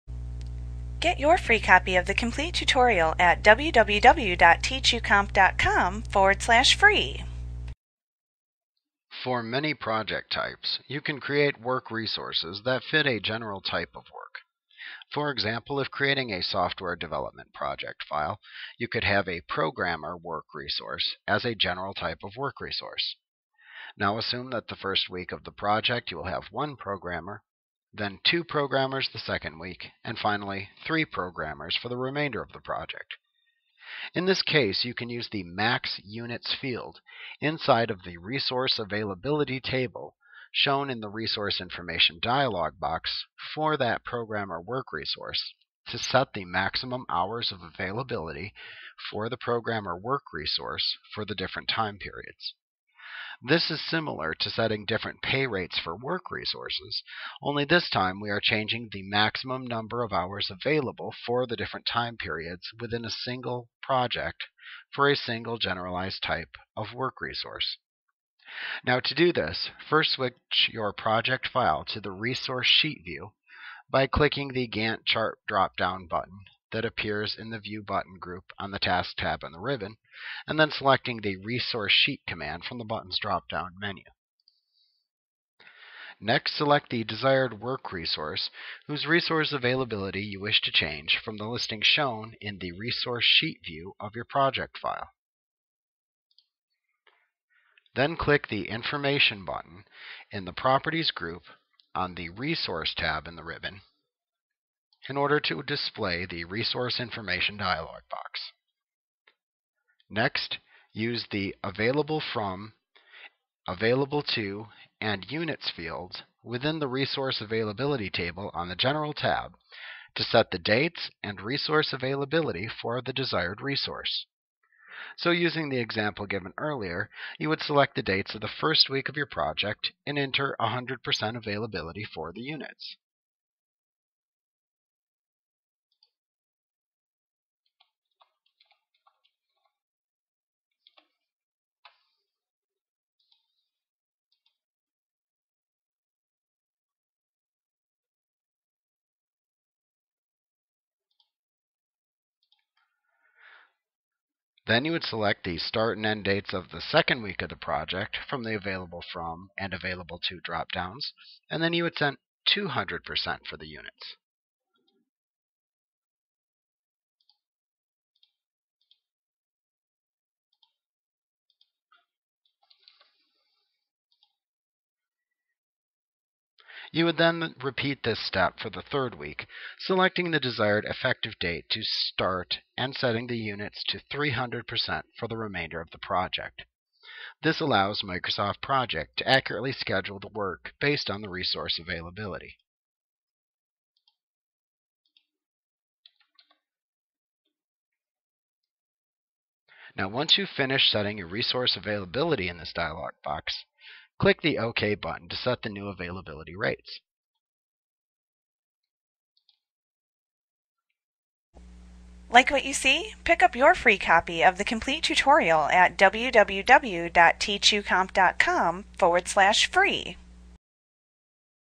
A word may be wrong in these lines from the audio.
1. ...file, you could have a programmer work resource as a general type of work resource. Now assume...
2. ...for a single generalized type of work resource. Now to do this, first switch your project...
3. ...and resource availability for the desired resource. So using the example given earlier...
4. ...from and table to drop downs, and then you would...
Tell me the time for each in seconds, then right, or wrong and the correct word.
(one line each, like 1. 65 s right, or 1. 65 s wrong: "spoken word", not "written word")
1. 18 s right
2. 64 s right
3. 121 s right
4. 159 s wrong: "available", not "table".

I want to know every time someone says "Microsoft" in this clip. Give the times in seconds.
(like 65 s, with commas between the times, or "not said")
188 s.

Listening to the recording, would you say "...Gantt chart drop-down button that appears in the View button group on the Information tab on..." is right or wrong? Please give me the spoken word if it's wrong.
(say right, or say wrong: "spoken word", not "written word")
wrong: "Task", not "Information".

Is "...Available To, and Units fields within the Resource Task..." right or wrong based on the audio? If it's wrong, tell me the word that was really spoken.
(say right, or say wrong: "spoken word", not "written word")
wrong: "Availability", not "Task".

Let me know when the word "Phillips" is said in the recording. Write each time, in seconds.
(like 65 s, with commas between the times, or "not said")
not said.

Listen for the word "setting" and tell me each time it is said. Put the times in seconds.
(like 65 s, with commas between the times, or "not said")
54 s, 182 s, 200 s.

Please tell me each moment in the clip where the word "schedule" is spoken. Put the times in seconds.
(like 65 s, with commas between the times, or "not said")
189 s.